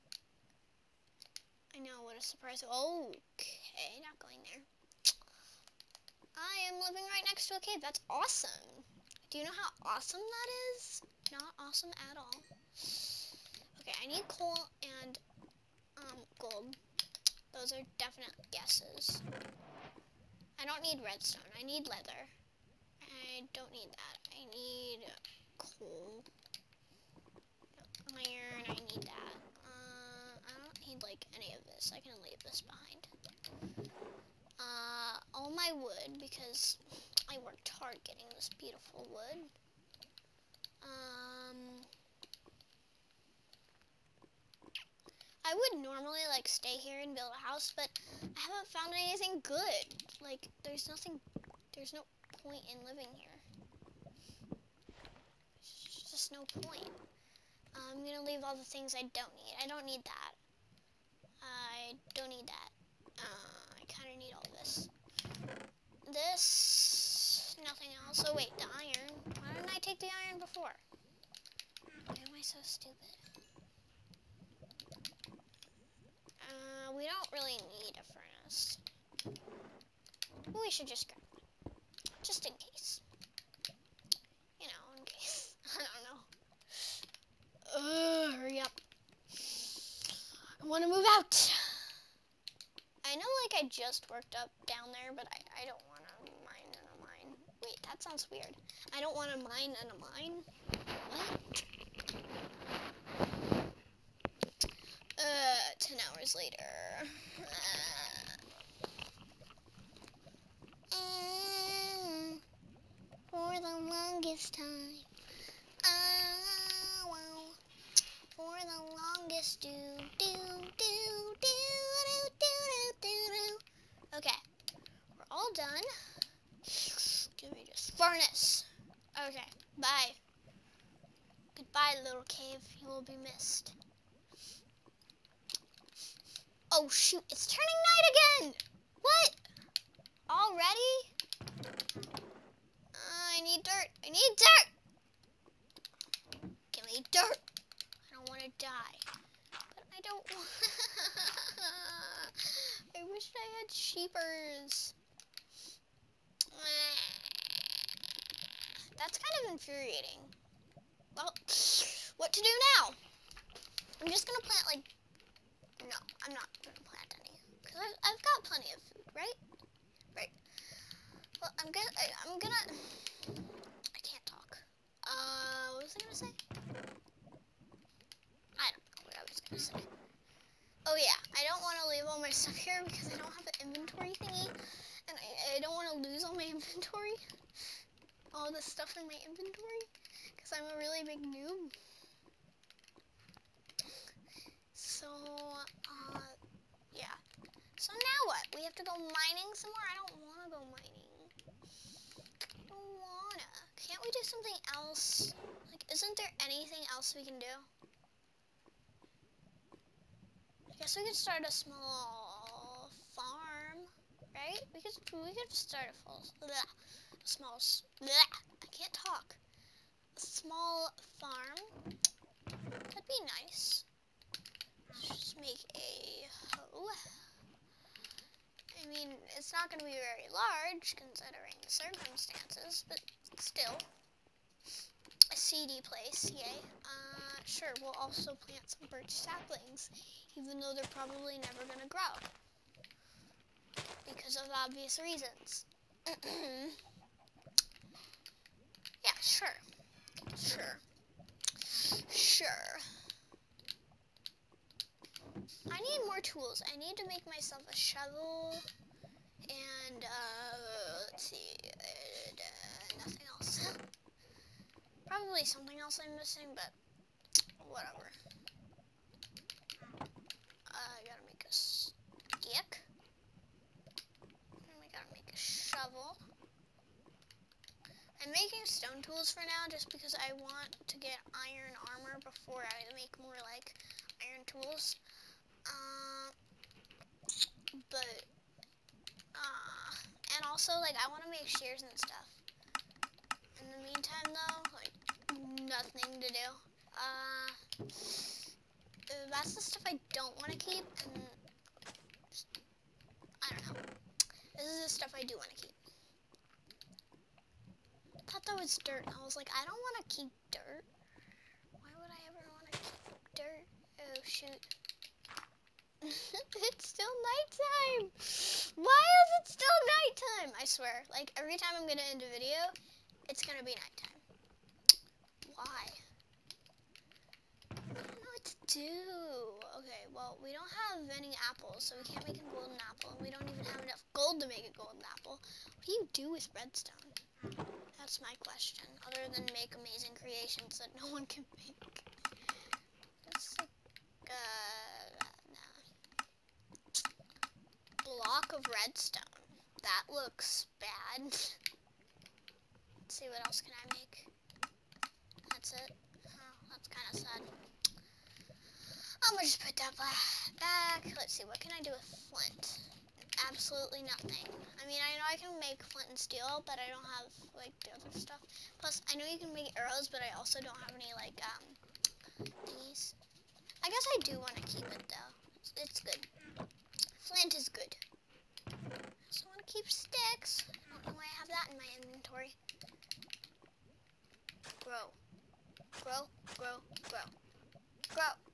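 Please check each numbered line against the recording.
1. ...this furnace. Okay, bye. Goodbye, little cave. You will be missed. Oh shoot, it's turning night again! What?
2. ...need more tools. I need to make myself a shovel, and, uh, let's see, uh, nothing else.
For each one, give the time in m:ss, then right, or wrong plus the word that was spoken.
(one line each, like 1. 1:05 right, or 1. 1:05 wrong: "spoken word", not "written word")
1. 2:07 right
2. 4:15 right.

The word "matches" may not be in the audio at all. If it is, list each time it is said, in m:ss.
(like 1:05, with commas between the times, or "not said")
not said.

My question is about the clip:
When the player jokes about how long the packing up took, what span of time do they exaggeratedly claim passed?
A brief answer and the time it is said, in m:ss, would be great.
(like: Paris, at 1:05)
10 hours, at 1:45.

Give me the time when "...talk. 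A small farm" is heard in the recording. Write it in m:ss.
3:38.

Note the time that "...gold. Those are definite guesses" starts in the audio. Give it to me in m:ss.
0:16.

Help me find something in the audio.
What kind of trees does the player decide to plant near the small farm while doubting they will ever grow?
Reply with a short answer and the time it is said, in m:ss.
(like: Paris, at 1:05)
Birch, at 3:58.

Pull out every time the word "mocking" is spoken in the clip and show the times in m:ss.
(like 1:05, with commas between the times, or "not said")
not said.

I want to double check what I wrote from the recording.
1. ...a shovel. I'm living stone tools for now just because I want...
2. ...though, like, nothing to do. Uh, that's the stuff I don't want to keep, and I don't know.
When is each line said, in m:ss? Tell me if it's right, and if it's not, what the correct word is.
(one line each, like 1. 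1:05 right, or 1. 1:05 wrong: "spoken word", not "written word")
1. 4:35 wrong: "making", not "living"
2. 4:54 right.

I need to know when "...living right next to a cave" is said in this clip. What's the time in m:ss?
0:06.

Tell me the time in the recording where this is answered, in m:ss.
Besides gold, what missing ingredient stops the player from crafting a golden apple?
5:31.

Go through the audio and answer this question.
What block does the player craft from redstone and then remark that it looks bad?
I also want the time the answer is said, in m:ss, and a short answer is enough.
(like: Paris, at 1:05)
Block of redstone, at 5:48.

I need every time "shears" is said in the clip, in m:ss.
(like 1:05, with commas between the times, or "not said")
4:51.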